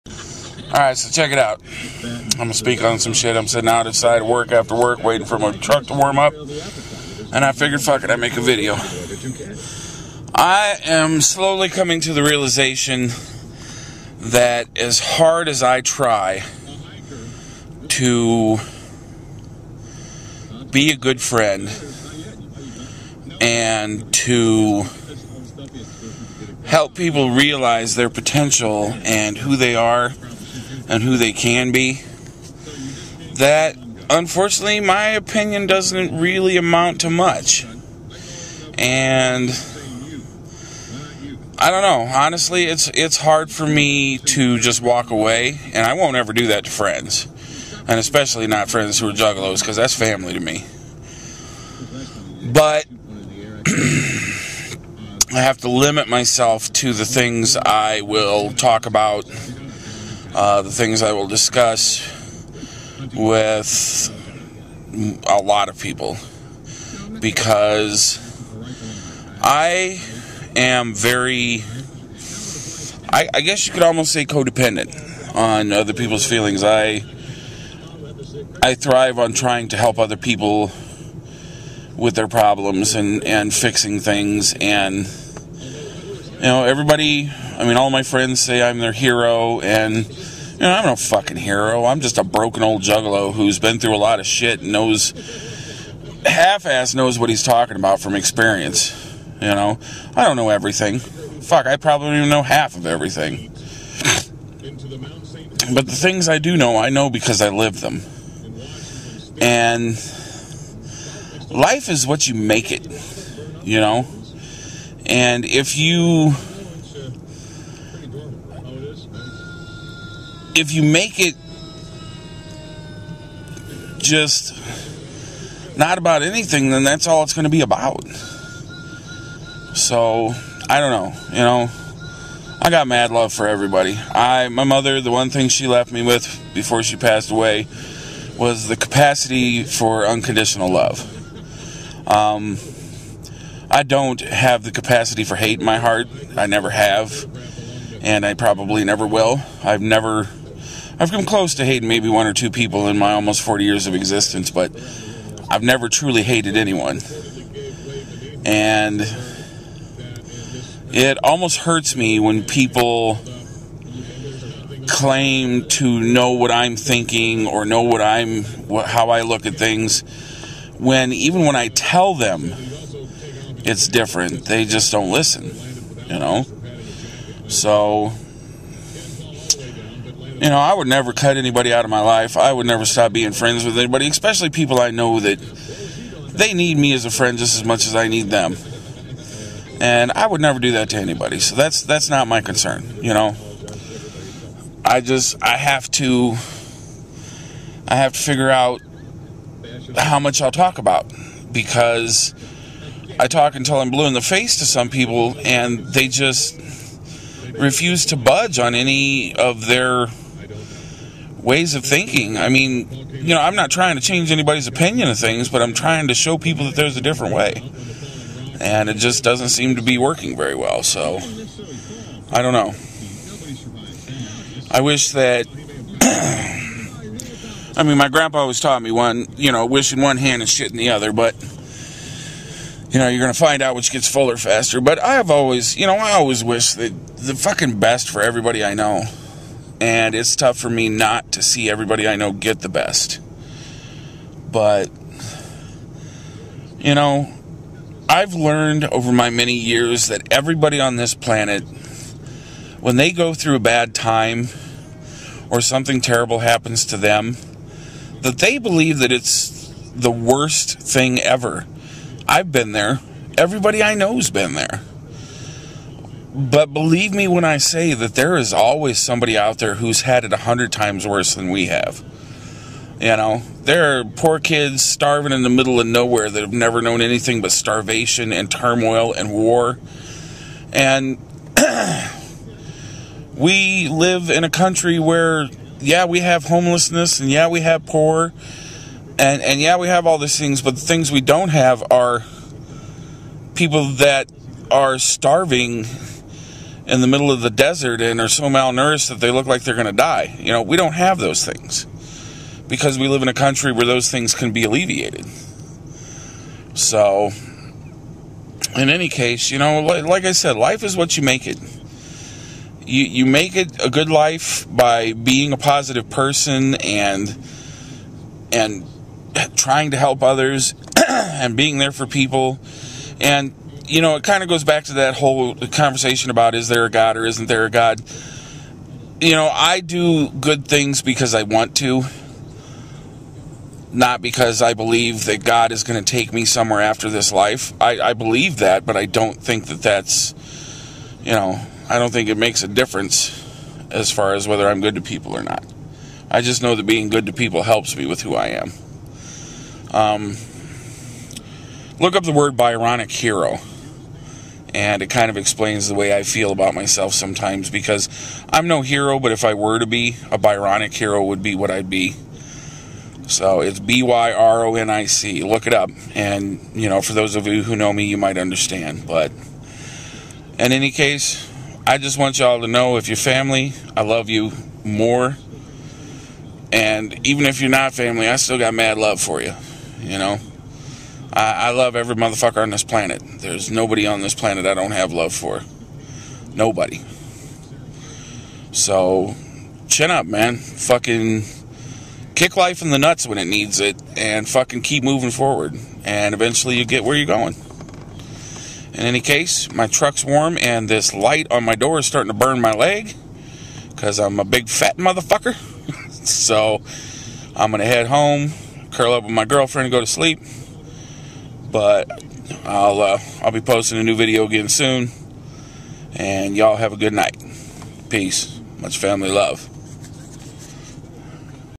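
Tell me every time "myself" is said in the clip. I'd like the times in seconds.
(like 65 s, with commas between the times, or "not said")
56 s, 356 s.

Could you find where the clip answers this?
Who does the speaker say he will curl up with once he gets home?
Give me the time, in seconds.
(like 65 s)
409 s.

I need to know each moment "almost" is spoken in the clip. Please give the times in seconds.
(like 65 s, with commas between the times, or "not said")
73 s, 153 s, 161 s.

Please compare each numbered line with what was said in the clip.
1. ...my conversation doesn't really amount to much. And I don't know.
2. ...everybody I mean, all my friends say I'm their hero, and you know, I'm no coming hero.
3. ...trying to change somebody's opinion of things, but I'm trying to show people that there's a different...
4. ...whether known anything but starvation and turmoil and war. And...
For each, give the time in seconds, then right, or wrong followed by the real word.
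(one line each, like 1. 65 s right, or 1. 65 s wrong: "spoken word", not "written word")
1. 34 s wrong: "opinion", not "conversation"
2. 86 s wrong: "fucking", not "coming"
3. 213 s wrong: "anybody", not "somebody"
4. 276 s wrong: "never", not "whether".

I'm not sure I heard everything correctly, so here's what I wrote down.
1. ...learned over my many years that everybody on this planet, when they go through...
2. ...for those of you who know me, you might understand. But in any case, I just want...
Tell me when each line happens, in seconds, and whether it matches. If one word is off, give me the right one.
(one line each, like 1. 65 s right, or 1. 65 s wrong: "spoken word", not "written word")
1. 248 s right
2. 367 s right.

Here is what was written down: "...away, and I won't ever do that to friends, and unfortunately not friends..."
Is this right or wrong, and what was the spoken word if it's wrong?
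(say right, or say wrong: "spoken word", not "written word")
wrong: "especially", not "unfortunately".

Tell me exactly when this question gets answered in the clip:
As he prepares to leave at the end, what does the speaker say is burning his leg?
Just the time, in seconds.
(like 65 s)
401 s.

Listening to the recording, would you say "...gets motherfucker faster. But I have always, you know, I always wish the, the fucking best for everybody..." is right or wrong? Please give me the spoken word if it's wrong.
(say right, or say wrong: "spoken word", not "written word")
wrong: "fuller", not "motherfucker".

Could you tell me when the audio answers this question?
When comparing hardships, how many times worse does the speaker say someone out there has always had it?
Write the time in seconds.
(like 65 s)
270 s.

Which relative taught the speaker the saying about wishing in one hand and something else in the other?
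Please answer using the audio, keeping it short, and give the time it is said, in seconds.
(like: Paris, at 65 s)
grandpa, at 228 s.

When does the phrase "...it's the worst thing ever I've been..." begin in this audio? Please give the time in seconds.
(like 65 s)
259 s.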